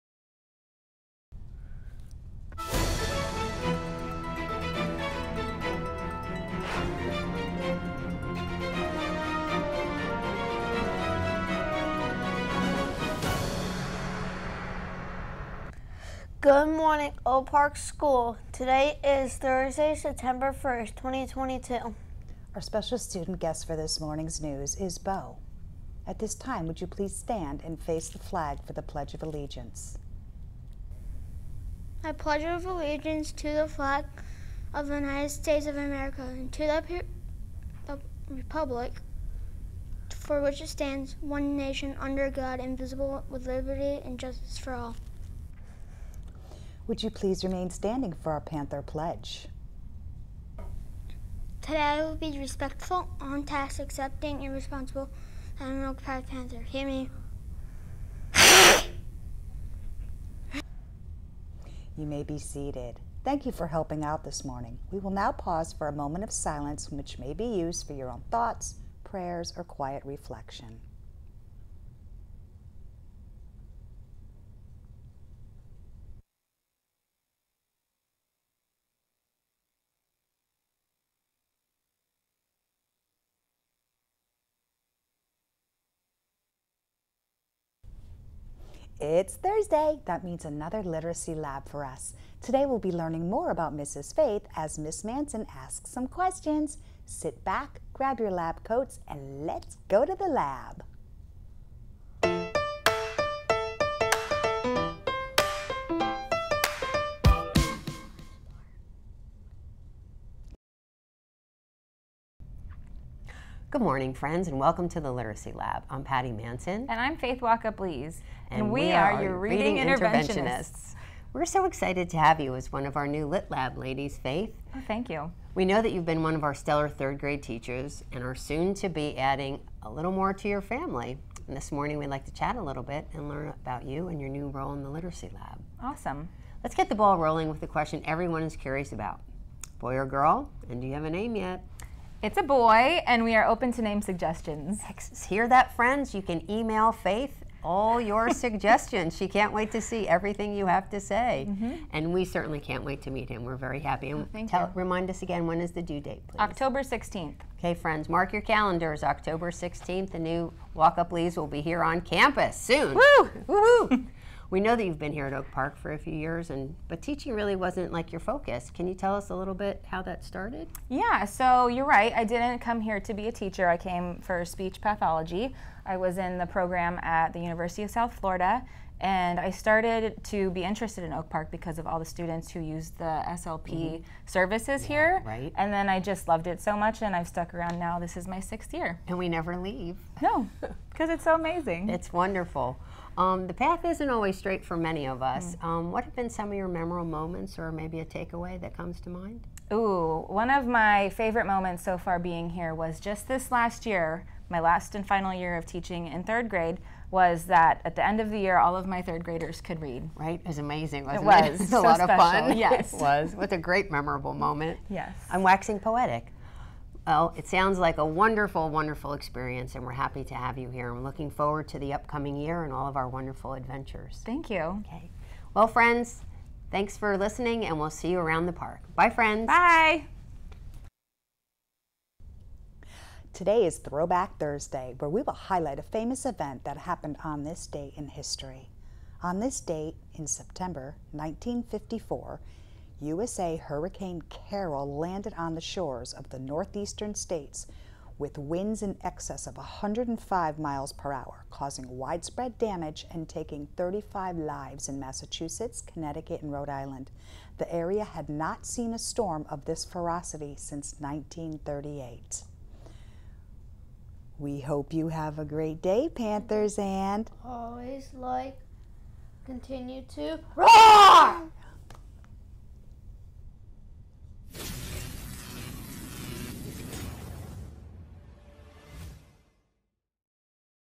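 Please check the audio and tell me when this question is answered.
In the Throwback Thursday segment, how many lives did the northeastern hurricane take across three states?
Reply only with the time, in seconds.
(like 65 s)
253 s.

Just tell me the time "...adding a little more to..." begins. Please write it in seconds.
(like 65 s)
129 s.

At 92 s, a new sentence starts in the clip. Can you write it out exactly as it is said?
Today we'll be learning more about Mrs.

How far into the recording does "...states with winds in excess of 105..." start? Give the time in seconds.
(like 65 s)
247 s.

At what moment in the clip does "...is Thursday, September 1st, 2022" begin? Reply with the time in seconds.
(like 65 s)
19 s.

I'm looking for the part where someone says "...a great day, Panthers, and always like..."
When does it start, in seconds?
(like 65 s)
265 s.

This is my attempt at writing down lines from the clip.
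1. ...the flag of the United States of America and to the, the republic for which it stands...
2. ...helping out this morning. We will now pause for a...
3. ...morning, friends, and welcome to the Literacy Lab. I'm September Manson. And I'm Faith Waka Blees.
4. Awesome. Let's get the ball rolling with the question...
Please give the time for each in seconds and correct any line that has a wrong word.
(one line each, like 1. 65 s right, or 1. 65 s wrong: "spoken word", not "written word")
1. 33 s right
2. 63 s right
3. 113 s wrong: "Patty", not "September"
4. 135 s right.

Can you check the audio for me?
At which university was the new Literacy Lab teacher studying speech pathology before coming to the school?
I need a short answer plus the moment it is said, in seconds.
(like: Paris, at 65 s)
University of South Florida, at 177 s.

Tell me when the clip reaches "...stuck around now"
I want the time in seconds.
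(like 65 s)
187 s.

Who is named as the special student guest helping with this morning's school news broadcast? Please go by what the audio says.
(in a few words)
Bo.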